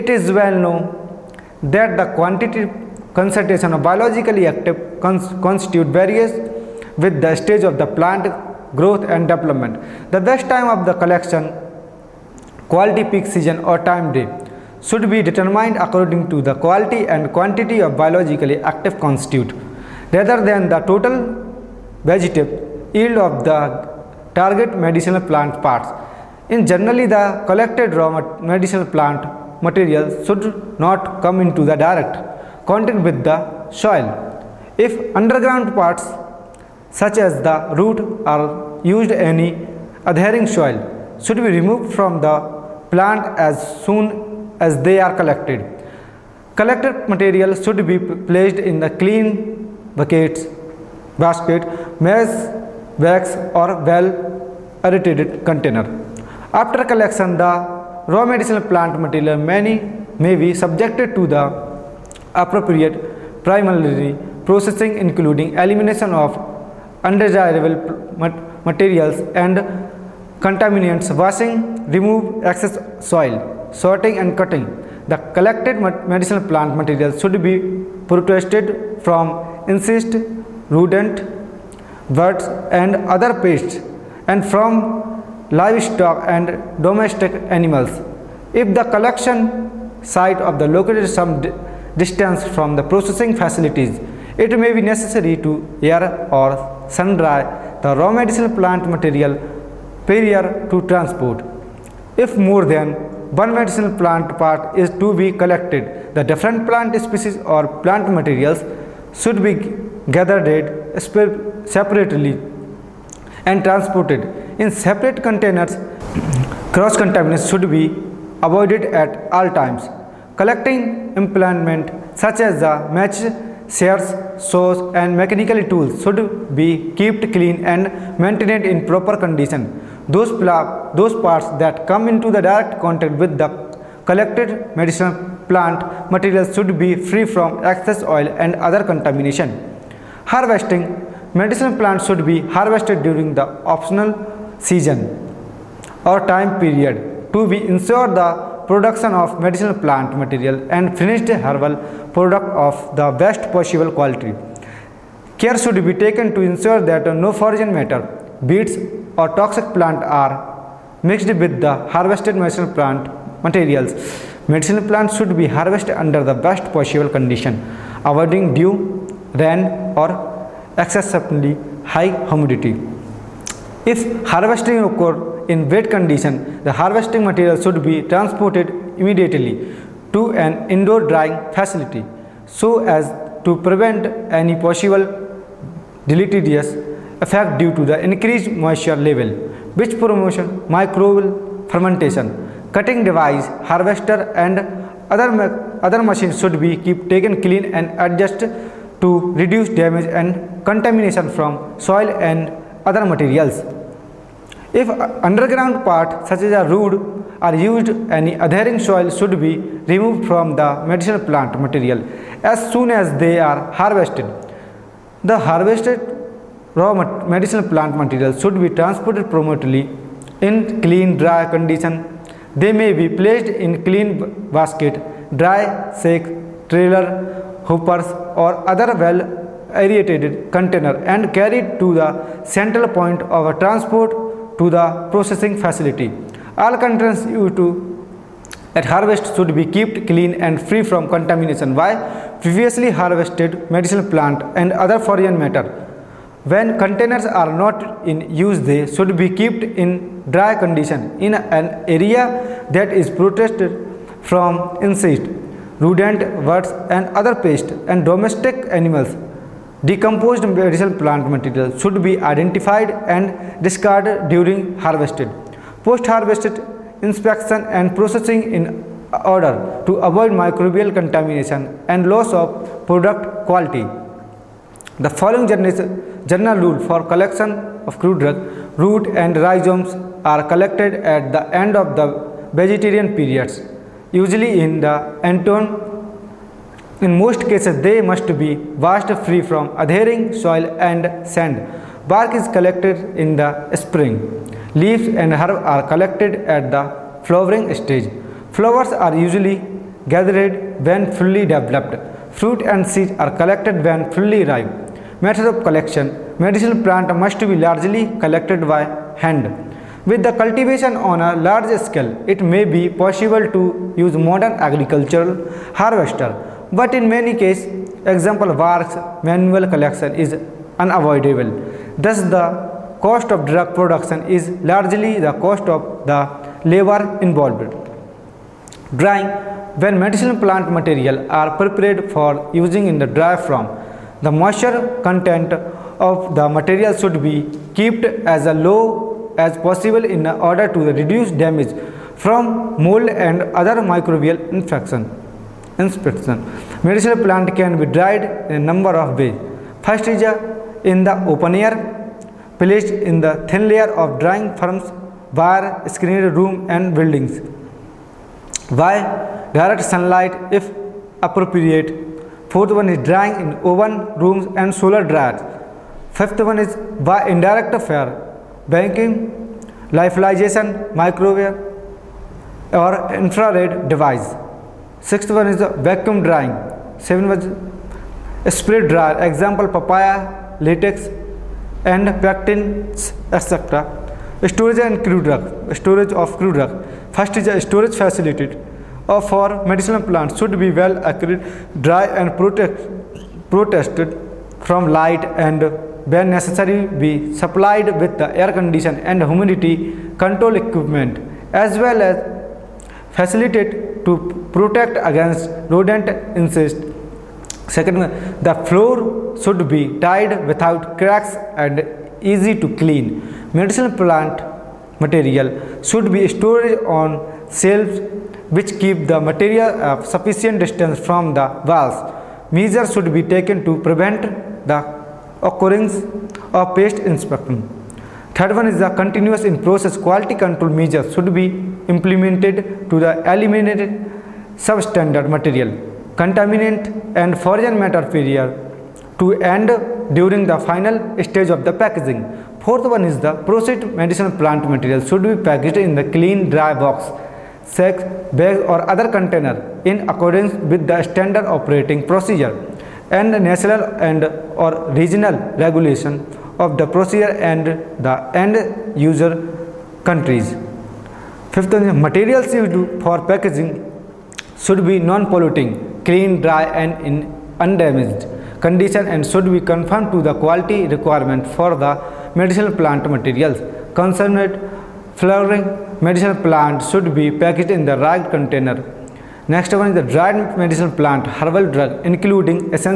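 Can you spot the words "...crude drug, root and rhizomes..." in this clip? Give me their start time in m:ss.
4:38.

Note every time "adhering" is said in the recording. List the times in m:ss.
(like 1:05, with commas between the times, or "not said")
0:40, 3:28, 4:49.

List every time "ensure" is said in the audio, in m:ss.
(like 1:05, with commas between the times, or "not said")
2:27, 2:36.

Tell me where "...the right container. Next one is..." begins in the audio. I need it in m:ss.
7:57.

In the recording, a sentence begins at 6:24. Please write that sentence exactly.
Storage and crude drug, storage of crude drug.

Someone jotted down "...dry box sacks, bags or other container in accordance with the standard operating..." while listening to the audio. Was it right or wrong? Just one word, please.
right.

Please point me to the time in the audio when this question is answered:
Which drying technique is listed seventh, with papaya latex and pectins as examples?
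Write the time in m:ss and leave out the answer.
6:18.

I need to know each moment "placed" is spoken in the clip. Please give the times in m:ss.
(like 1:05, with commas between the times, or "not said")
0:48, 3:43, 5:52.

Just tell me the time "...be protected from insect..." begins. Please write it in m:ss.
1:17.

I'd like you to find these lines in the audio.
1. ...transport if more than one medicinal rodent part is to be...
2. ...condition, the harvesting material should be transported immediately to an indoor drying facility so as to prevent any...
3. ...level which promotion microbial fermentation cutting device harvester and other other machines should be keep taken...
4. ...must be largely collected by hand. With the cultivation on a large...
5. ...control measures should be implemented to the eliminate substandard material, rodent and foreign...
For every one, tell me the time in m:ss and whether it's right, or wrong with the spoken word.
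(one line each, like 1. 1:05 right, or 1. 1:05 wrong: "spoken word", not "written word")
1. 1:40 wrong: "plant", not "rodent"
2. 2:55 right
3. 3:09 right
4. 5:07 right
5. 7:10 wrong: "contaminant", not "rodent".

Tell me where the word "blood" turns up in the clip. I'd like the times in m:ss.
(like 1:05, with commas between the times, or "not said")
not said.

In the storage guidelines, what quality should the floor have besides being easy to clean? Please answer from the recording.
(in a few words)
Without cracks.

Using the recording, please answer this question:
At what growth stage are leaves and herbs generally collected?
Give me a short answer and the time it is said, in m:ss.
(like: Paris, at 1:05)
Flowering stage, at 4:57.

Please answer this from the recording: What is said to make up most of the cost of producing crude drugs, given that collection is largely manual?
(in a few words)
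Labor.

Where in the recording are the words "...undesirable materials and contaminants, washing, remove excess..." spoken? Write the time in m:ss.
1:07.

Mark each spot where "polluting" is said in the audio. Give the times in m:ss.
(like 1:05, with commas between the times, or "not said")
7:44.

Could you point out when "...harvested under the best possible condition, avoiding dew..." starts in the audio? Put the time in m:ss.
2:45.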